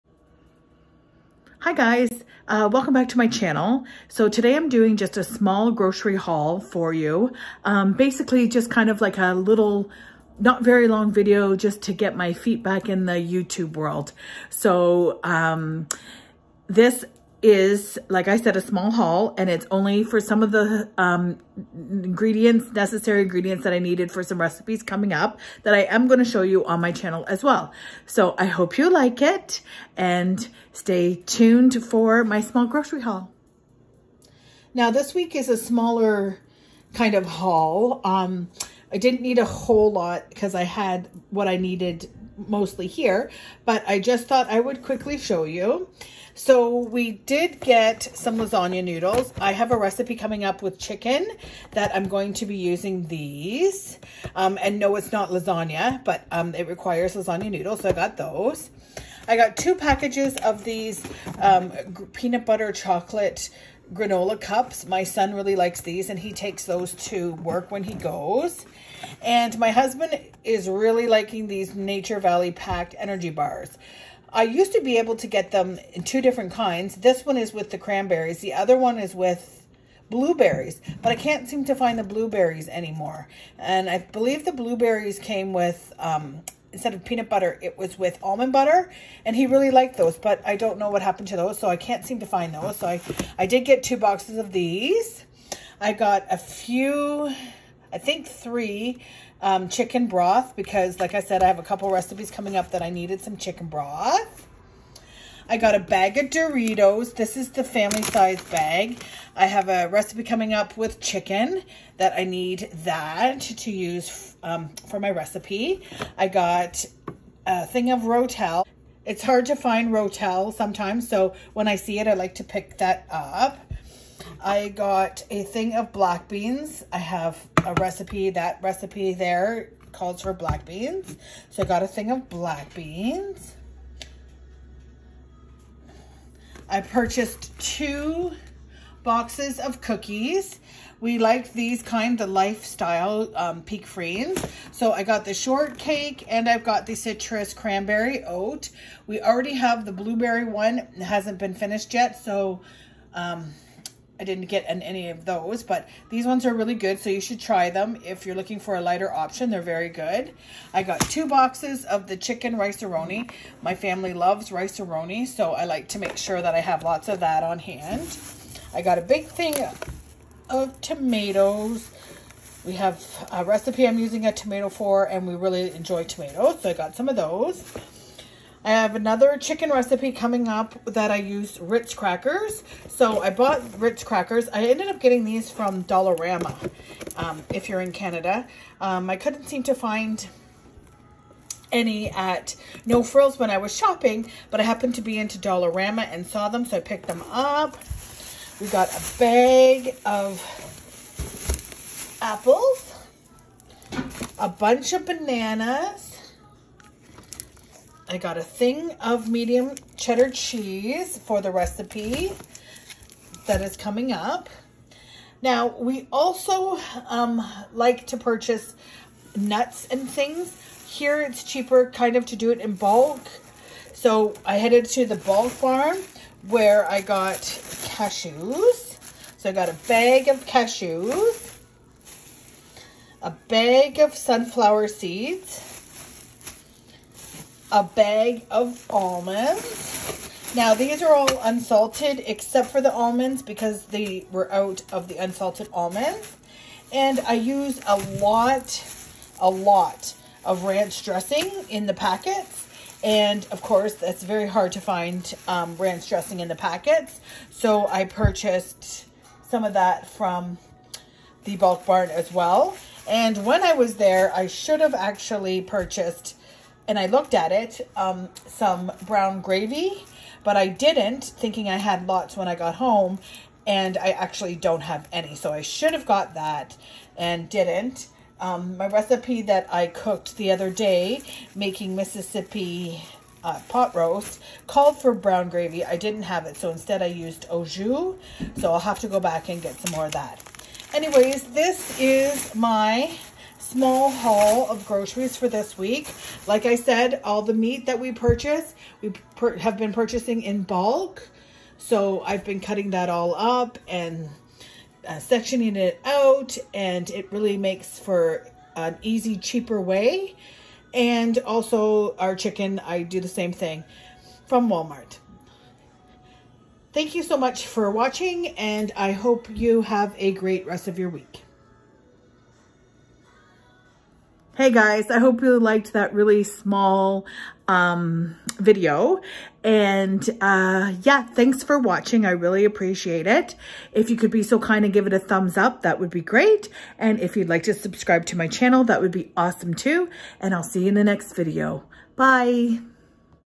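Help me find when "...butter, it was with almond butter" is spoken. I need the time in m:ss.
1:27.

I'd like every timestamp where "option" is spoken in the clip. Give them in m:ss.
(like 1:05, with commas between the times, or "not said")
2:39.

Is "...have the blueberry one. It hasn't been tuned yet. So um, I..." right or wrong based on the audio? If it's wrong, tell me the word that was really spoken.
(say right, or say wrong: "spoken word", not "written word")
wrong: "finished", not "tuned".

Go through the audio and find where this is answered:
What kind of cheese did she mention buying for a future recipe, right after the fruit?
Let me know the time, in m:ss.
3:29.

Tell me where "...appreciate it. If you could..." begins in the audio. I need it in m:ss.
5:32.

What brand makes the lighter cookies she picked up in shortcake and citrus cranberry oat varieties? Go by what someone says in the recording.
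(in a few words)
Peek Freans.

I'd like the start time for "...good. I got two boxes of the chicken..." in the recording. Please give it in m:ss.
2:39.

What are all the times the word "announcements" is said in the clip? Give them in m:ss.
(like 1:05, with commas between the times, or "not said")
not said.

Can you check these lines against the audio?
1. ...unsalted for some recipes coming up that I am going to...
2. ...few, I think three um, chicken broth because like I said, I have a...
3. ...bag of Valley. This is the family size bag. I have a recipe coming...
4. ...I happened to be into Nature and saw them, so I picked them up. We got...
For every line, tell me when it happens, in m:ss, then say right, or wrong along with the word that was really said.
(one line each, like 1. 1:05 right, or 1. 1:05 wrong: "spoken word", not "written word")
1. 0:23 wrong: "needed", not "unsalted"
2. 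1:36 right
3. 1:45 wrong: "Doritos", not "Valley"
4. 3:14 wrong: "Dollarama", not "Nature".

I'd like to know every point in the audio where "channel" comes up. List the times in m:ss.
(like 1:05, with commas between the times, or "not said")
0:03, 0:26, 5:38.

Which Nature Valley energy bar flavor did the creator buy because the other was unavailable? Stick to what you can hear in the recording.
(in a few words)
Cranberries.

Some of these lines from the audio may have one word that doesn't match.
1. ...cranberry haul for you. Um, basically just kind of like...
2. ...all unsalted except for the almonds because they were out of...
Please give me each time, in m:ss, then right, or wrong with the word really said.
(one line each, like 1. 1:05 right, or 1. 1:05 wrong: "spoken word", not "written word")
1. 0:05 wrong: "grocery", not "cranberry"
2. 4:01 right.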